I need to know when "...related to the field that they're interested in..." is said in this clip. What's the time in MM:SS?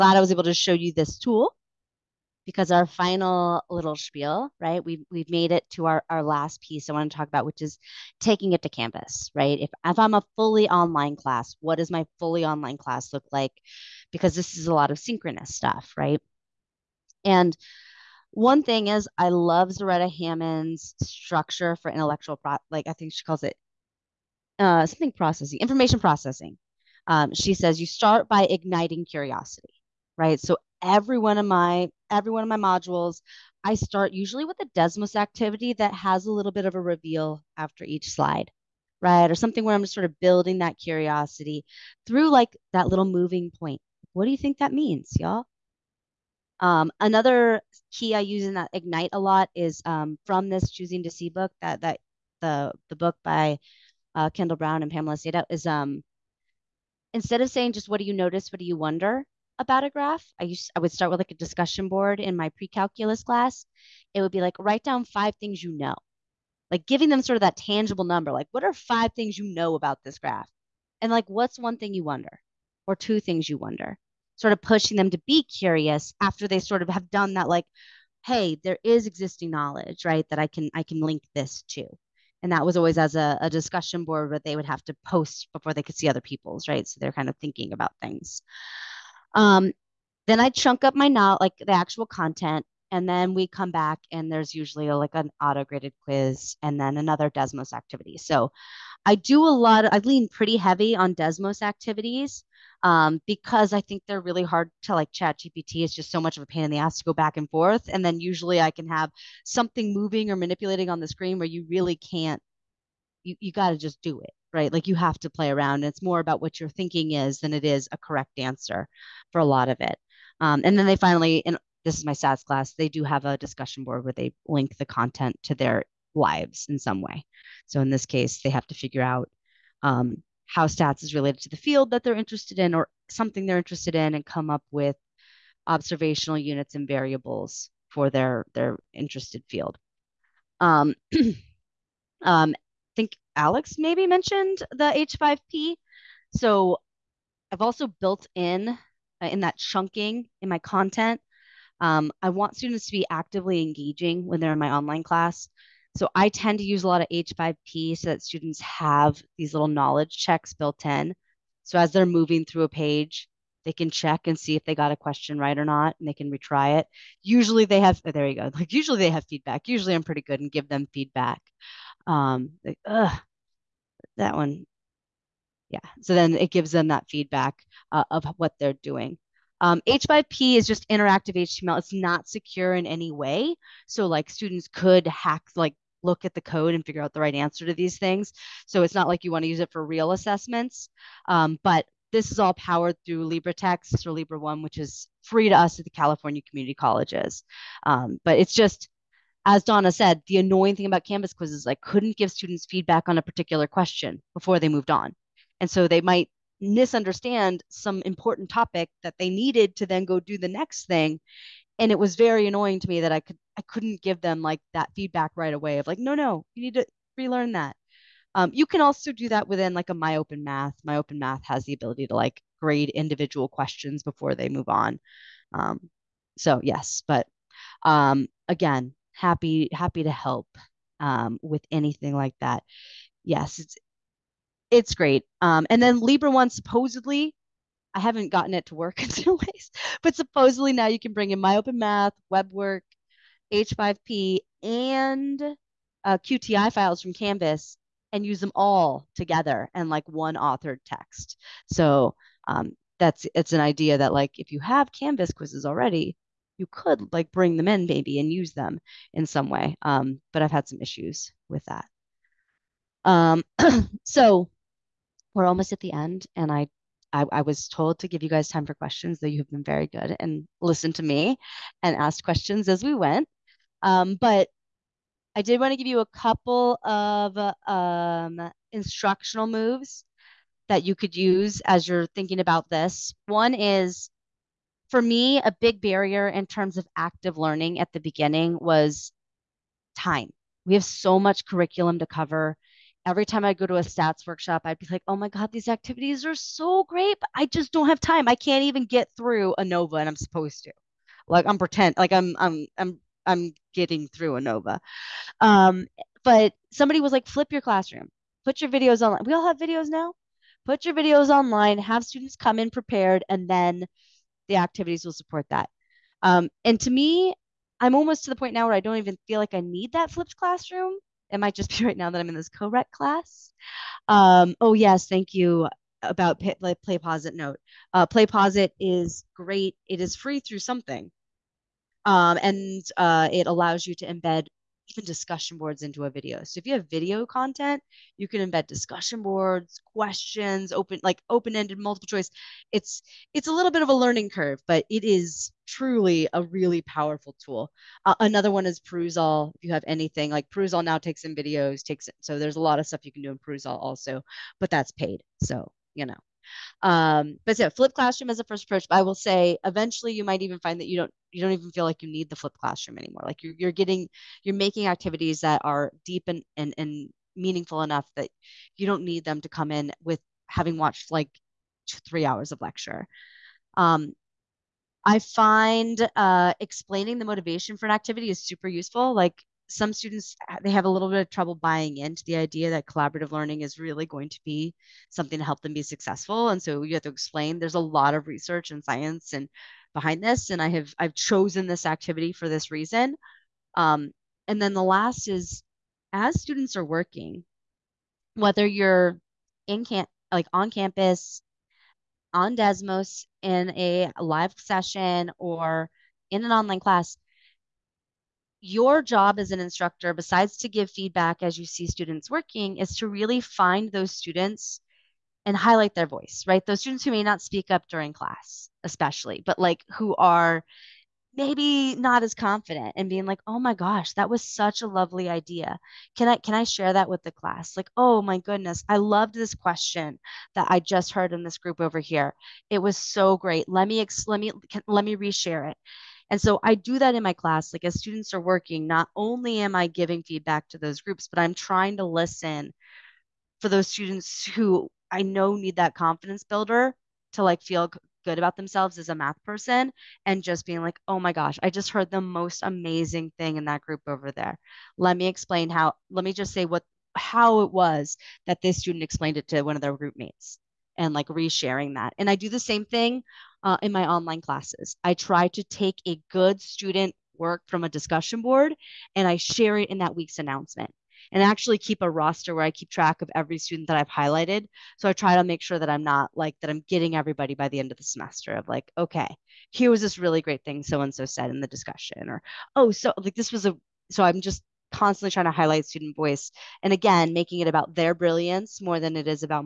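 02:11.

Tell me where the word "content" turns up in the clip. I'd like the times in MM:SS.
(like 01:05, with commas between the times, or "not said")
01:32, 02:04, 02:30, 05:37.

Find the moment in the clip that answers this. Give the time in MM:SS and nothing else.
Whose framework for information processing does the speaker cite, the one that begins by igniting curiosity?
00:19.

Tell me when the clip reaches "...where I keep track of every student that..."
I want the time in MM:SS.
07:52.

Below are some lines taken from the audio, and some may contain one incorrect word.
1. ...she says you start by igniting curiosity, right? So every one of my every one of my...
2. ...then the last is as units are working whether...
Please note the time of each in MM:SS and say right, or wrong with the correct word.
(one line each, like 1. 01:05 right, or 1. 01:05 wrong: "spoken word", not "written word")
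1. 00:27 right
2. 06:34 wrong: "students", not "units".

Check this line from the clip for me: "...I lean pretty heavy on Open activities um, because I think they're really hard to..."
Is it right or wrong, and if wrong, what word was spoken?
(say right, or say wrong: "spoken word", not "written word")
wrong: "Desmos", not "Open".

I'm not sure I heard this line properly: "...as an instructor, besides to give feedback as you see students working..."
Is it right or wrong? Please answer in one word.
right.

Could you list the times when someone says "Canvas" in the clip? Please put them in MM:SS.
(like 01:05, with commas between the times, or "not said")
03:21, 04:07, 04:14.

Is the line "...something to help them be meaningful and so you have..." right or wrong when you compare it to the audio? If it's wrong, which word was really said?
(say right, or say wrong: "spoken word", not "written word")
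wrong: "successful", not "meaningful".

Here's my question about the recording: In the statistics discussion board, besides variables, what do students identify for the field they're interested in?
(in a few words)
observational units.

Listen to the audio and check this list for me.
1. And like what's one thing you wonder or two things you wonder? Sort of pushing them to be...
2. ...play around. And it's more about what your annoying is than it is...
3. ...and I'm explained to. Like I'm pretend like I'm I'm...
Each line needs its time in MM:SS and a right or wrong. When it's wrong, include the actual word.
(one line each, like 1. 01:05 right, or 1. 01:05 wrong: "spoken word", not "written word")
1. 01:11 right
2. 01:55 wrong: "thinking", not "annoying"
3. 05:00 wrong: "supposed", not "explained".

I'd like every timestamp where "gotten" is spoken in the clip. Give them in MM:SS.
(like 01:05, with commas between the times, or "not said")
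03:58.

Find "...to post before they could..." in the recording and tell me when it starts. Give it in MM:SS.
01:24.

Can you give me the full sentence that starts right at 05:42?
It's it's a little bit of a learning curve, but it is truly a really powerful tool.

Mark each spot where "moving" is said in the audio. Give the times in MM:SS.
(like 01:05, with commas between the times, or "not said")
00:43, 01:49, 02:42.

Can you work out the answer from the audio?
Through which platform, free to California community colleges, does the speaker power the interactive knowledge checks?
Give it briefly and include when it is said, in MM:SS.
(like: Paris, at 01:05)
LibreText, at 03:13.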